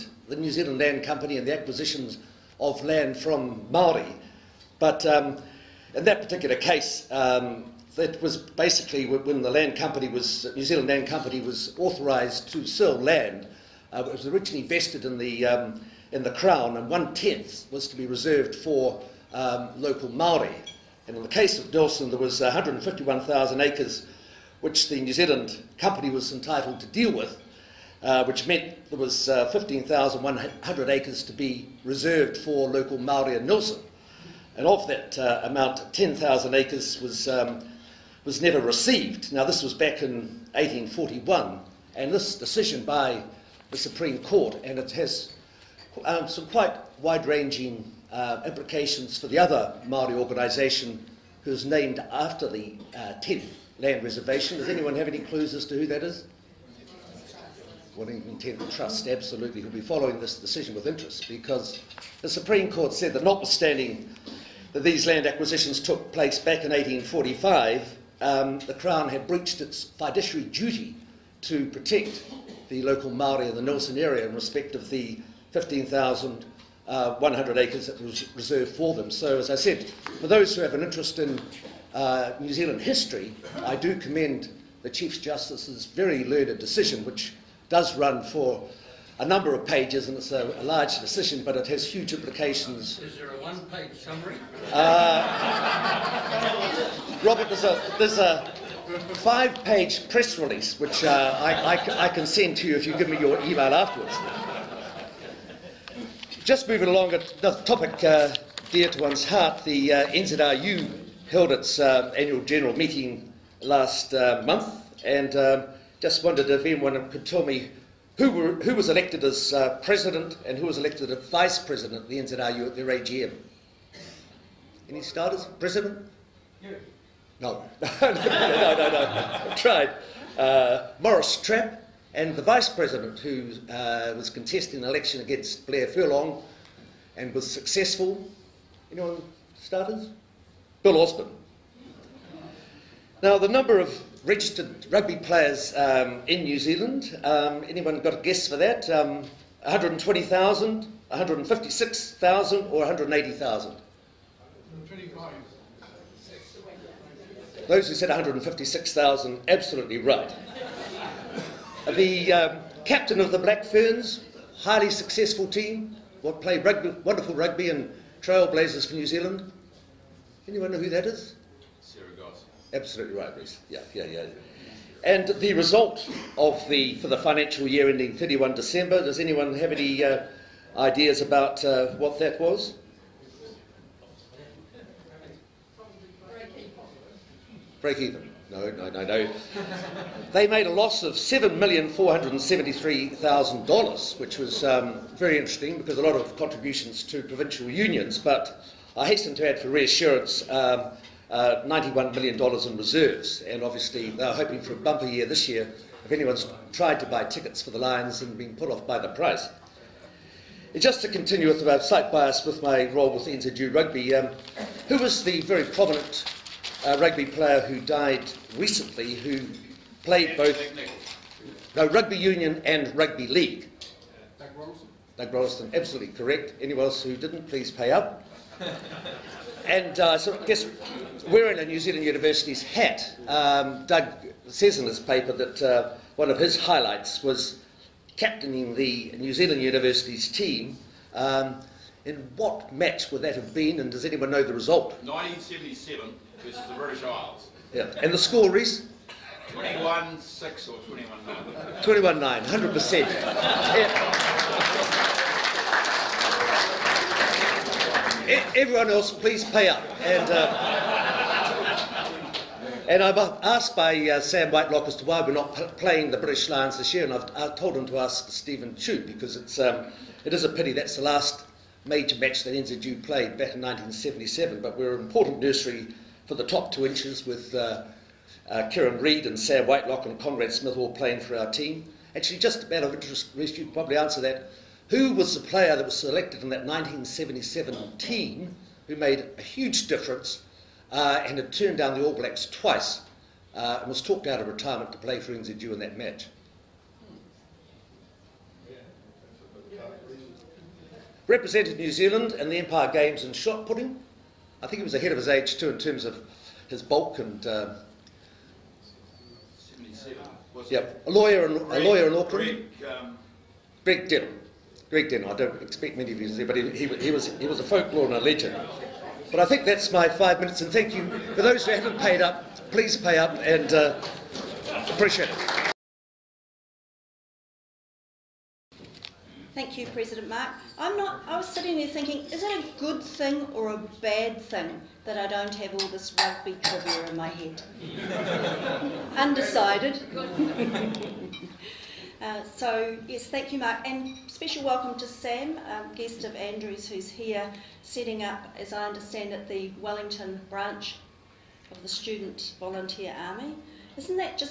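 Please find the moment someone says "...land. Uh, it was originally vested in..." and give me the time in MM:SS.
00:12.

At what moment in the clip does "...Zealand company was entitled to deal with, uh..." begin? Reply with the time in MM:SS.
00:25.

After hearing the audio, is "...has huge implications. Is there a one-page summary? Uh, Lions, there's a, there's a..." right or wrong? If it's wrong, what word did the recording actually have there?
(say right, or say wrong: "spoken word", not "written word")
wrong: "Robert", not "Lions".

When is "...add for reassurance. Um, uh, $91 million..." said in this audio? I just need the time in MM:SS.
03:19.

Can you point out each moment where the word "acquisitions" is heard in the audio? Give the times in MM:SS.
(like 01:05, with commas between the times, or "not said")
00:01, 01:05.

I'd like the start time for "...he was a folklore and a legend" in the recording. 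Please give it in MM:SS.
05:17.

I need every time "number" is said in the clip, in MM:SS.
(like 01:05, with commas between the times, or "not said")
01:29, 02:23.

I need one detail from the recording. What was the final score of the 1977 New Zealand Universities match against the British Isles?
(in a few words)
21-9.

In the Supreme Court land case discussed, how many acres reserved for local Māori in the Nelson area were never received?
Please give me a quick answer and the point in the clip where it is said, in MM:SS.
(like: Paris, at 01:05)
10,000 acres, at 00:35.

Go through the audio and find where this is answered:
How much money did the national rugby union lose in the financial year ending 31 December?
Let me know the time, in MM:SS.
03:11.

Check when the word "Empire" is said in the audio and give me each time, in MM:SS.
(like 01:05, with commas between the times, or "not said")
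05:02.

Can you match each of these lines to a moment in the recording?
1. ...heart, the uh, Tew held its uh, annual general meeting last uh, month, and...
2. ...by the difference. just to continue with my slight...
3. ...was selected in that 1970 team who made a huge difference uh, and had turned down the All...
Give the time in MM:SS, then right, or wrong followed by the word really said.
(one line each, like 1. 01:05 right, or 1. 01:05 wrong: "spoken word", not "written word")
1. 01:49 wrong: "NZRU", not "Tew"
2. 03:28 wrong: "price", not "difference"
3. 04:45 wrong: "1977", not "1970".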